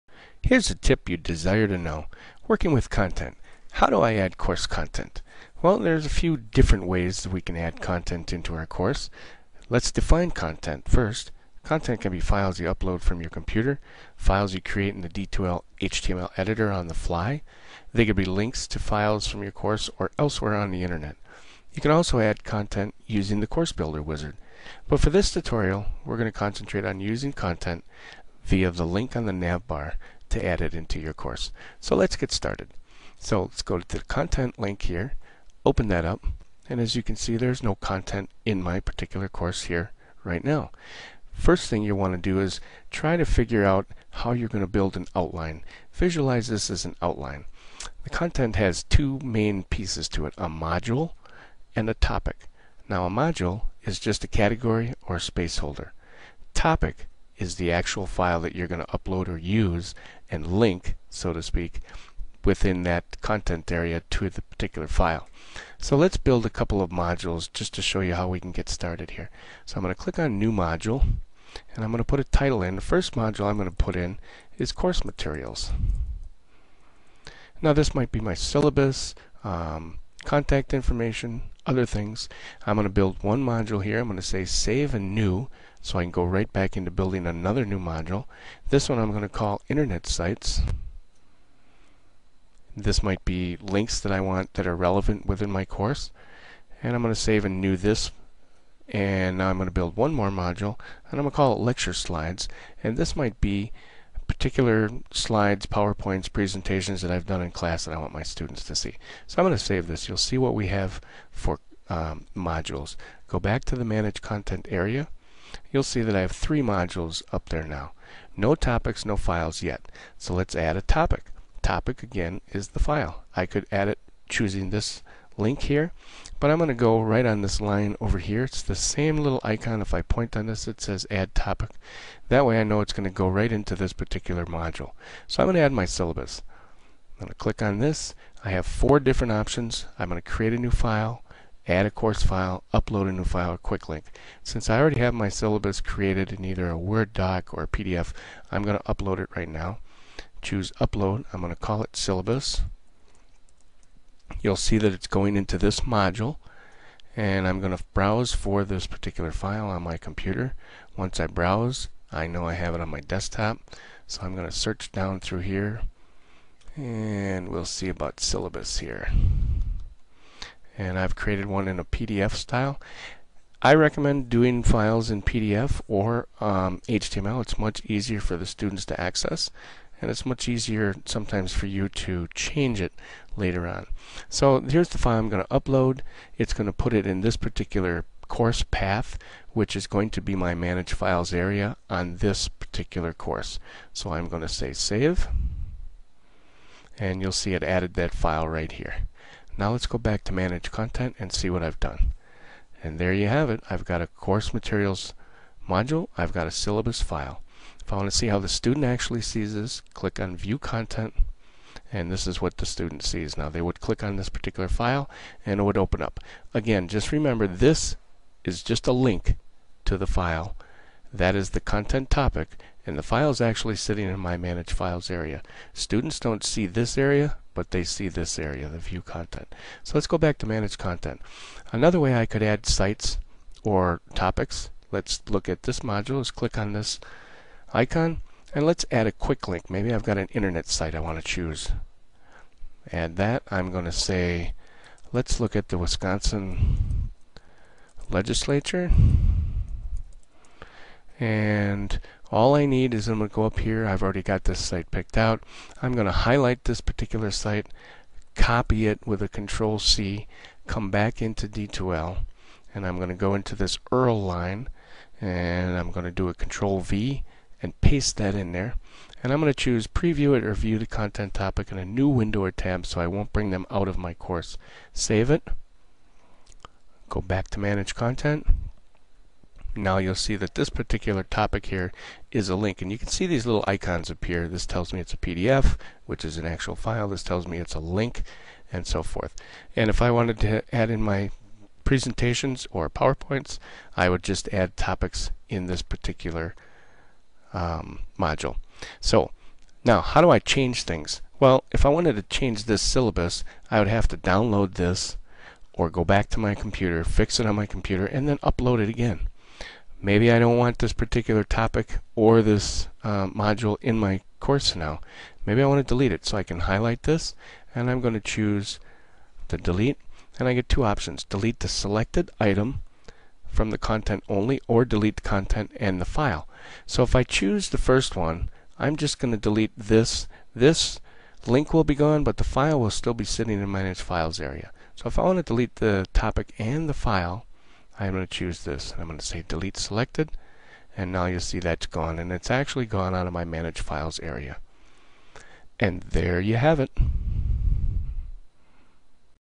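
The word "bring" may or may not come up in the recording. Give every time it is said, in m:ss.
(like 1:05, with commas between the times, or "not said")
4:33.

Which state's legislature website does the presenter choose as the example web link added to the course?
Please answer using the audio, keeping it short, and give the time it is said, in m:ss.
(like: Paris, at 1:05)
Wisconsin, at 4:05.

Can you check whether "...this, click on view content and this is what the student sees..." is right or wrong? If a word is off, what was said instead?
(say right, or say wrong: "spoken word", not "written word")
right.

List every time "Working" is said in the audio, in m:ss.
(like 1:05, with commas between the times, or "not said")
0:02.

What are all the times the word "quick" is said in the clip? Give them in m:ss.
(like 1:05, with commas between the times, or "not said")
2:23, 3:59.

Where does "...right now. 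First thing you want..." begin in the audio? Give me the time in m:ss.
0:40.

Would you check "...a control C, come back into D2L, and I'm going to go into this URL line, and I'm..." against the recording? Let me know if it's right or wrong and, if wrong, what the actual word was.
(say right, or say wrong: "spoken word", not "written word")
right.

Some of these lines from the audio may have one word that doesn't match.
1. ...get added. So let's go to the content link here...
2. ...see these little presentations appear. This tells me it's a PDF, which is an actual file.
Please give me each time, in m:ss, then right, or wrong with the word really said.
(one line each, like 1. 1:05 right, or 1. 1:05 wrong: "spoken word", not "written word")
1. 0:32 wrong: "started", not "added"
2. 4:43 wrong: "icons", not "presentations".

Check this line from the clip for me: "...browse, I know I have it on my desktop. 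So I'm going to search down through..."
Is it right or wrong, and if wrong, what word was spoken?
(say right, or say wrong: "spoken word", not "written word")
right.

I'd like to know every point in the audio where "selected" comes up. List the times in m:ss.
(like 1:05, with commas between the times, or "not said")
5:21, 5:39.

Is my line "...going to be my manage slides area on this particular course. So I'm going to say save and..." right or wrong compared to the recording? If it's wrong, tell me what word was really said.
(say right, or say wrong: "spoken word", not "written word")
wrong: "files", not "slides".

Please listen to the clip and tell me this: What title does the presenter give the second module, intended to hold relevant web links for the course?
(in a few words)
Internet Sites.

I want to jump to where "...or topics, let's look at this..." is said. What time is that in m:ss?
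3:53.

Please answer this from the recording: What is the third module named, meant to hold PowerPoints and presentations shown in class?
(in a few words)
Lecture Slides.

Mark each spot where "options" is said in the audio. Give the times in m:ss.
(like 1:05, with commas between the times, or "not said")
2:19, 5:20.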